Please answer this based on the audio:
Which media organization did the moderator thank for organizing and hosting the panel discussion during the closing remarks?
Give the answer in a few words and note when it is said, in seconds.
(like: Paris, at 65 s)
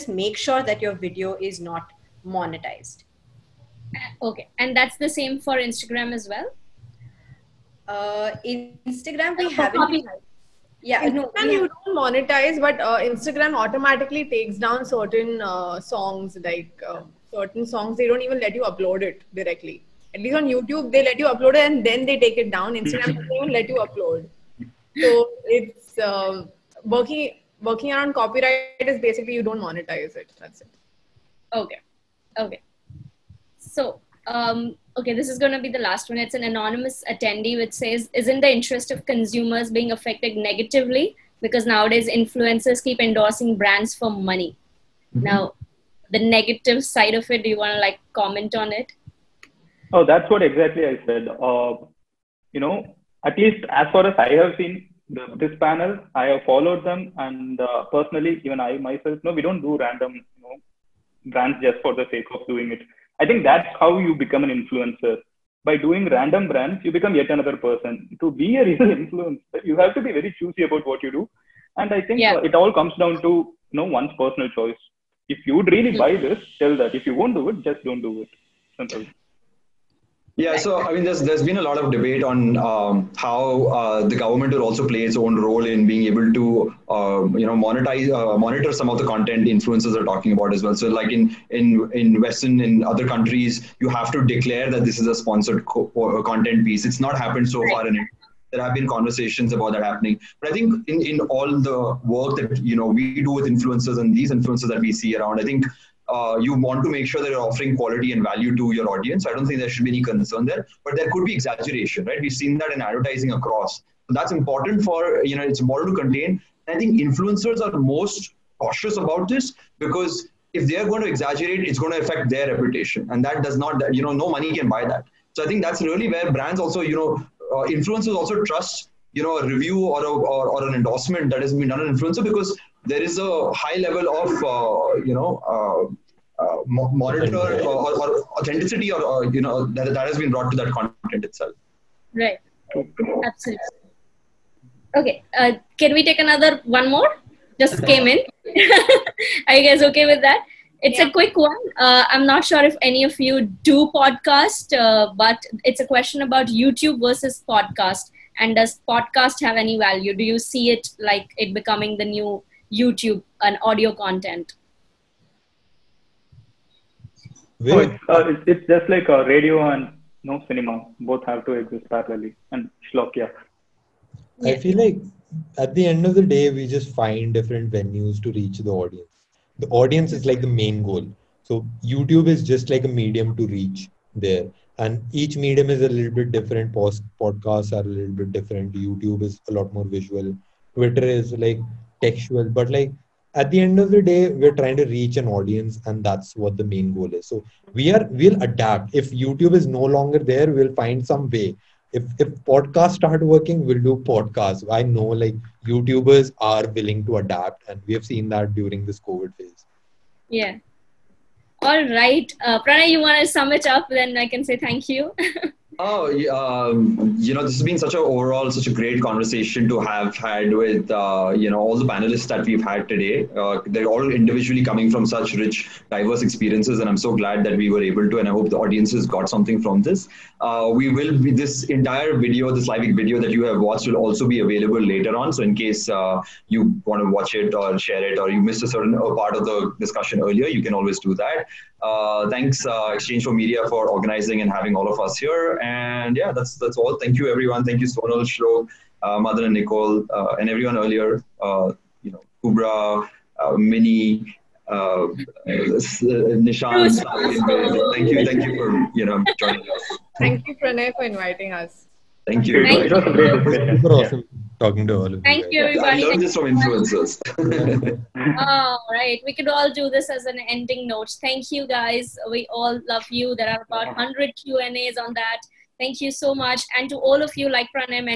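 exchange4media, at 242 s.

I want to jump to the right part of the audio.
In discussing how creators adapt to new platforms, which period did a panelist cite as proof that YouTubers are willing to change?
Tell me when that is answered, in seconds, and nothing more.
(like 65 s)
208 s.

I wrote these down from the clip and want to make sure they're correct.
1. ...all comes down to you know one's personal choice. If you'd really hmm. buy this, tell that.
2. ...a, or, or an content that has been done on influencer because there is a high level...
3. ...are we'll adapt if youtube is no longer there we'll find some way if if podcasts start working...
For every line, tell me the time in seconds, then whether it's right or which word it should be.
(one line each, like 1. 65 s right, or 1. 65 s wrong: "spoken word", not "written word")
1. 72 s right
2. 130 s wrong: "endorsement", not "content"
3. 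197 s right.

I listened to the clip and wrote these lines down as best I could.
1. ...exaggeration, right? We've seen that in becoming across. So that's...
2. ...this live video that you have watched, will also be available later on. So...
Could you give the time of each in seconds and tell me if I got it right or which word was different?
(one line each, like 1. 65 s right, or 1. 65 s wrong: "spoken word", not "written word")
1. 111 s wrong: "advertising", not "becoming"
2. 232 s right.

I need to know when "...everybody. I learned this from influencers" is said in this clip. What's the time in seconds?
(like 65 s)
265 s.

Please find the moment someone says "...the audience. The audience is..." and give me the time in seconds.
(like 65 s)
178 s.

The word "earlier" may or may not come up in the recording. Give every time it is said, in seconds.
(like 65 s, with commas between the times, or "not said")
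240 s, 250 s.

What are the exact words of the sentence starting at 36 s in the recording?
It's an anonymous attendee which says, isn't the interest of consumers being affected negatively?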